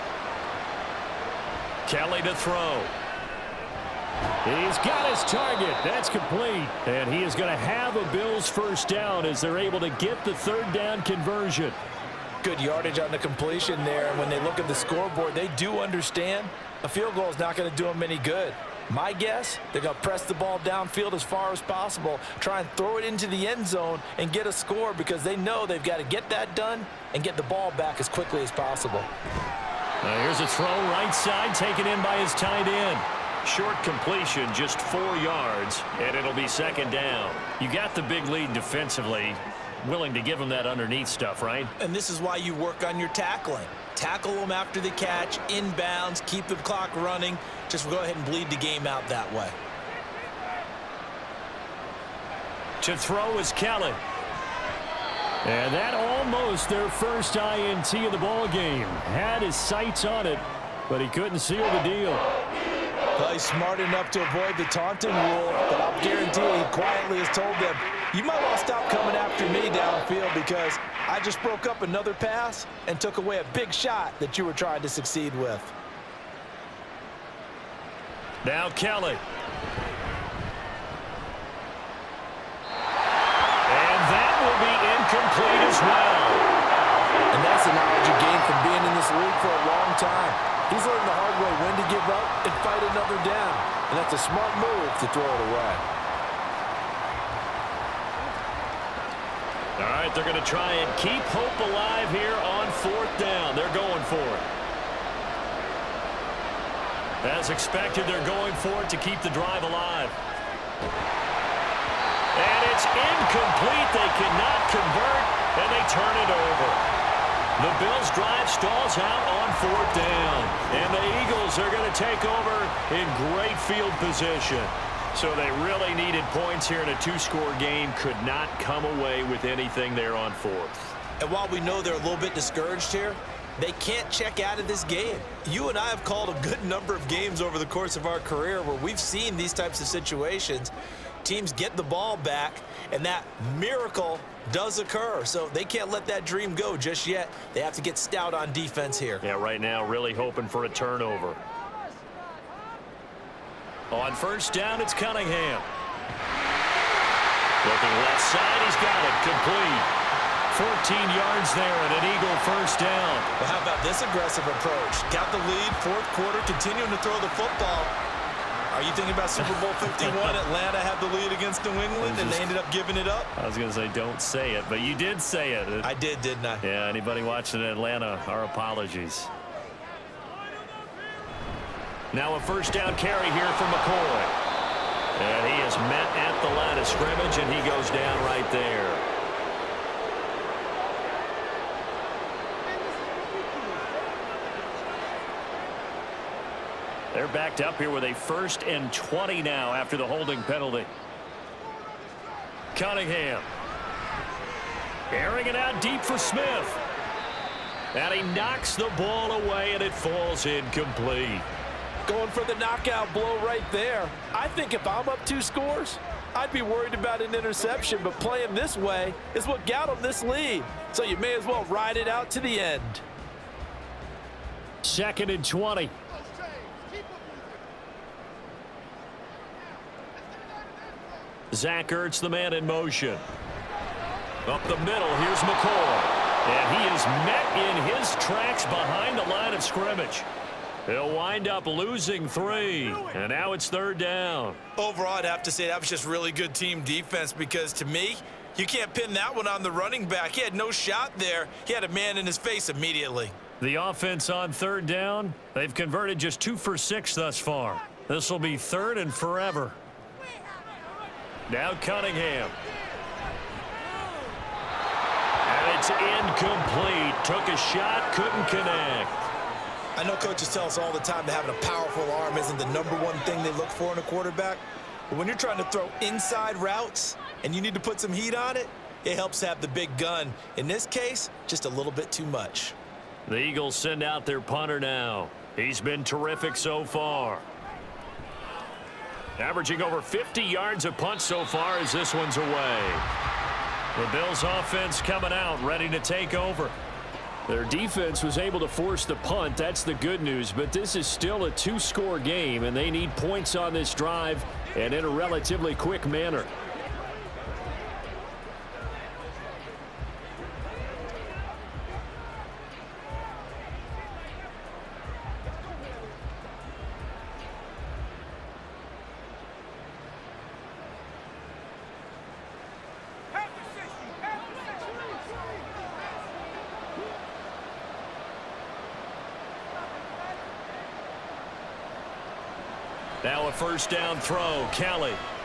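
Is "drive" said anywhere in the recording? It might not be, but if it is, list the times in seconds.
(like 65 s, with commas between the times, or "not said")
109 s, 118 s, 303 s.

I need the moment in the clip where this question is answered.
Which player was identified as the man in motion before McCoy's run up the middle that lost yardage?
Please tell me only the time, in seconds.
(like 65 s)
231 s.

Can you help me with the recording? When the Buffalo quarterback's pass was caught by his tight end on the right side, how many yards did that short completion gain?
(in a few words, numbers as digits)
4.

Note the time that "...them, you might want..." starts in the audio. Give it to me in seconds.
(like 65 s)
67 s.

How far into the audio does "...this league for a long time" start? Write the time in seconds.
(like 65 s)
88 s.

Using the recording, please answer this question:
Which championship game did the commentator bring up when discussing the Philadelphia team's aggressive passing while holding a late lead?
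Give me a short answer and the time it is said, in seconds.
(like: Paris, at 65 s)
Super Bowl 51, at 169 s.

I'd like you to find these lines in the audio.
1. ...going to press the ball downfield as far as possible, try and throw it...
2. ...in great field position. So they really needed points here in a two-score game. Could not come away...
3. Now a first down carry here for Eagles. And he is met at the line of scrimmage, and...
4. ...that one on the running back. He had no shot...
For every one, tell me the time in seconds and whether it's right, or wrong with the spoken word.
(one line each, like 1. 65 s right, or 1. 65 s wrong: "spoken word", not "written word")
1. 19 s right
2. 122 s right
3. 182 s wrong: "McCoy", not "Eagles"
4. 249 s right.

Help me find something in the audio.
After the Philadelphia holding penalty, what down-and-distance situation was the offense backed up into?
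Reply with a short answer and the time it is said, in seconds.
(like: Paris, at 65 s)
First and 20, at 198 s.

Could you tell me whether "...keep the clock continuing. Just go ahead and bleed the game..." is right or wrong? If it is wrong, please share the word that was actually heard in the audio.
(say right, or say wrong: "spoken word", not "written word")
wrong: "running", not "continuing".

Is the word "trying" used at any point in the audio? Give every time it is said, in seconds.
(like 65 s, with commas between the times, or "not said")
74 s, 275 s.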